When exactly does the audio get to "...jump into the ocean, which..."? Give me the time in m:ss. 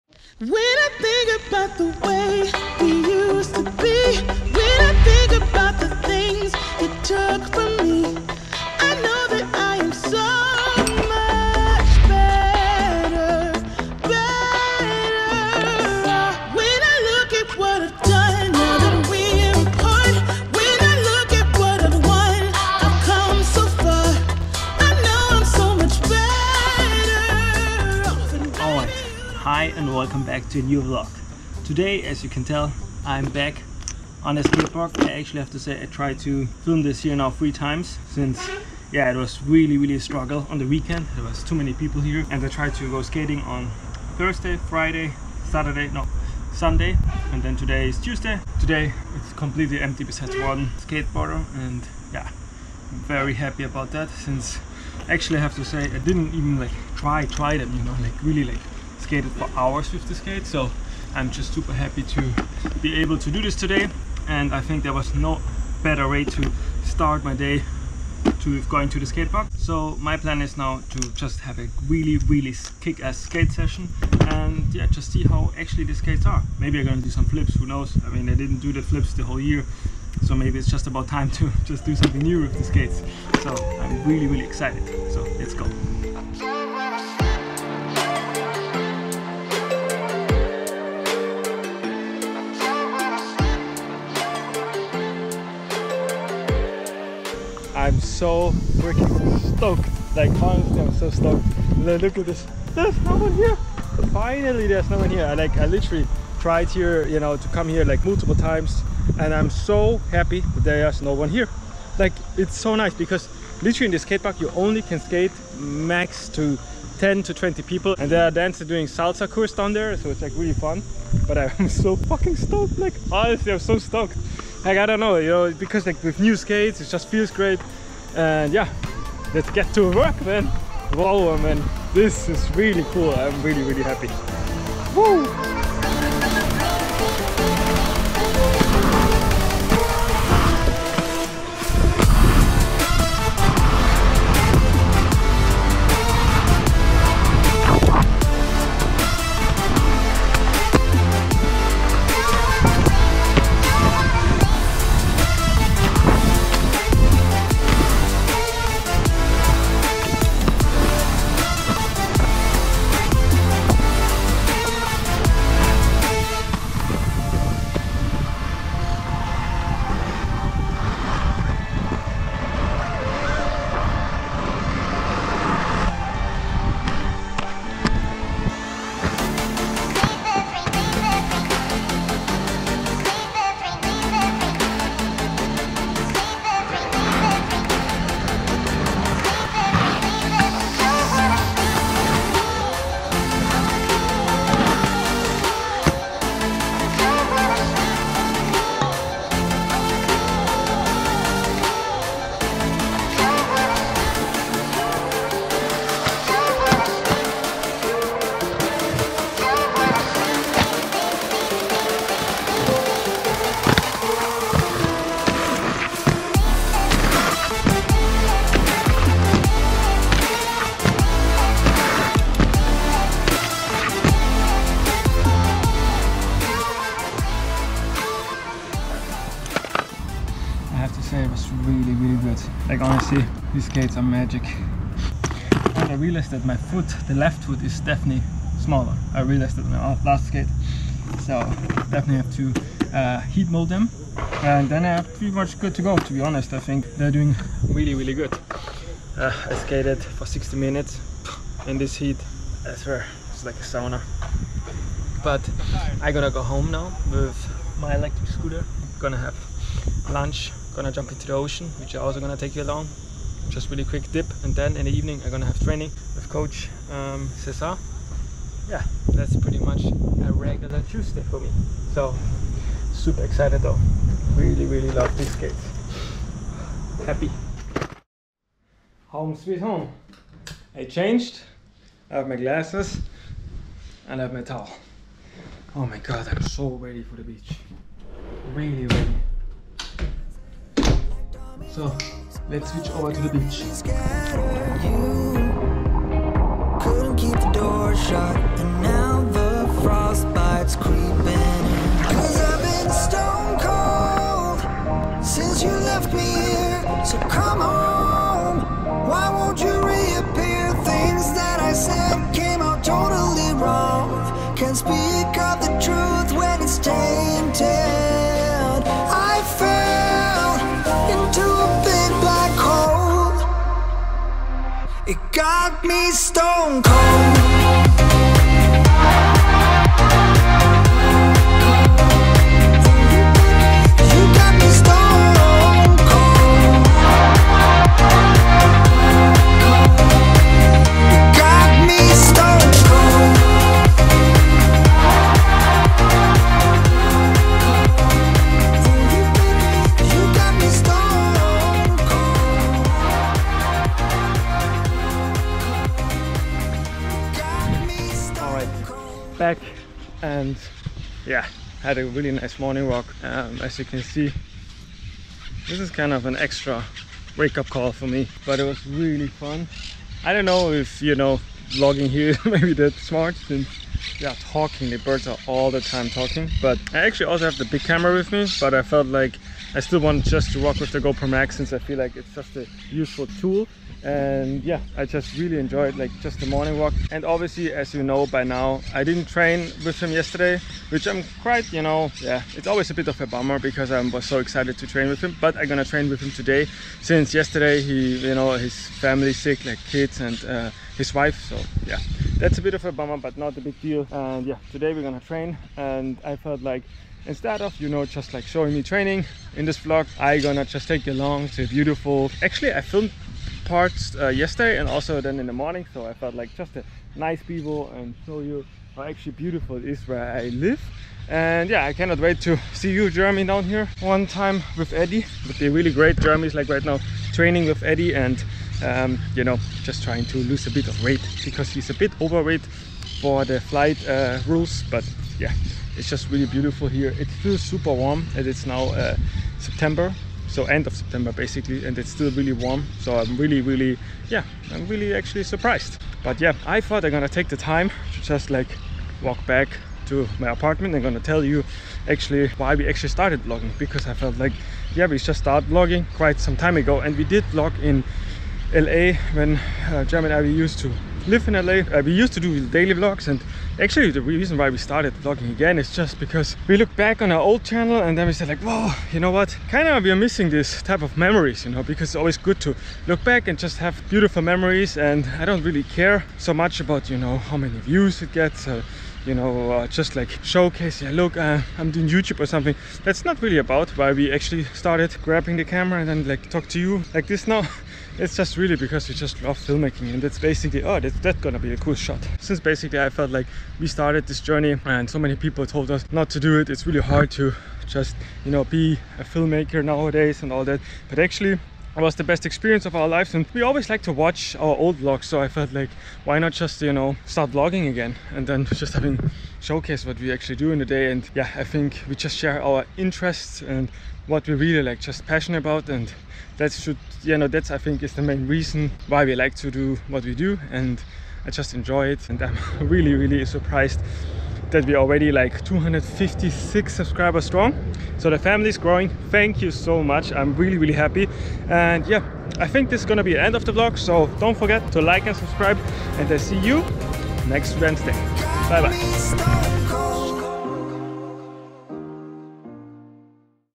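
4:20.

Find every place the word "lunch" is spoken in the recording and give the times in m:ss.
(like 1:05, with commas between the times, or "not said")
4:20.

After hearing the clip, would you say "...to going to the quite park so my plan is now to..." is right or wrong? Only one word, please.
wrong.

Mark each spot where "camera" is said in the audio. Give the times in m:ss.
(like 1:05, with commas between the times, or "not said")
6:17, 8:05.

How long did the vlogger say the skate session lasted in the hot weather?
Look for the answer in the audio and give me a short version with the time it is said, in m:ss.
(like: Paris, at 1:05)
60 minutes, at 4:10.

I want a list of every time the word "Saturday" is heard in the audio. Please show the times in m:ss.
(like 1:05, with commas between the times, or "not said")
0:45.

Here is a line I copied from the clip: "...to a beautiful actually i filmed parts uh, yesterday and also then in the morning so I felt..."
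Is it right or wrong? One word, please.
right.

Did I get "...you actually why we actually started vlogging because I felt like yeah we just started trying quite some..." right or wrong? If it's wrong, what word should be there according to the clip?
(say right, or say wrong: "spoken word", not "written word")
wrong: "vlogging", not "trying".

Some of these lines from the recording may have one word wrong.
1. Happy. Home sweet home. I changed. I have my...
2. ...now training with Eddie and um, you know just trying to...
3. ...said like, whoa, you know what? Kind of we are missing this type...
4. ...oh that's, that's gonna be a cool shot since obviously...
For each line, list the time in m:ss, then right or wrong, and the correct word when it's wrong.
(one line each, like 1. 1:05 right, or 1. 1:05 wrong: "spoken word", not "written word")
1. 4:37 right
2. 7:06 right
3. 7:48 right
4. 8:10 wrong: "basically", not "obviously".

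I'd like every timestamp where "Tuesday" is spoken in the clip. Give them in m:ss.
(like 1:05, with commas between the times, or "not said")
0:47, 4:30.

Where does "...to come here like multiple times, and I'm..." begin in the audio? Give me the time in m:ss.
1:47.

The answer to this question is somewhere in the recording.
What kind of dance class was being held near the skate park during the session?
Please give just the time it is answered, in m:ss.
1:58.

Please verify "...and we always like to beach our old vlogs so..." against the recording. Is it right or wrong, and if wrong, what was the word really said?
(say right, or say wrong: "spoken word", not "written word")
wrong: "watch", not "beach".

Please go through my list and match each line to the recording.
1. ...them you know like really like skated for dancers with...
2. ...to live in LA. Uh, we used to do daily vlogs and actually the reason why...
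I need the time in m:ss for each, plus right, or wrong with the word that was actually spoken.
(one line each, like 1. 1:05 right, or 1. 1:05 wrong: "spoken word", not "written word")
1. 0:57 wrong: "hours", not "dancers"
2. 7:40 right.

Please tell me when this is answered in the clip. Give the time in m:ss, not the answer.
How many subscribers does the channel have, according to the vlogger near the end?
8:45.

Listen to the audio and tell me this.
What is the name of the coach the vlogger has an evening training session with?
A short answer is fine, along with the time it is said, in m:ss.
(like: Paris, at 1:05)
Cesar, at 4:27.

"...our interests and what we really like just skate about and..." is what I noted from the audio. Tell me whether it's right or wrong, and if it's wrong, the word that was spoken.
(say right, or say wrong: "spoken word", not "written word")
wrong: "passionate", not "skate".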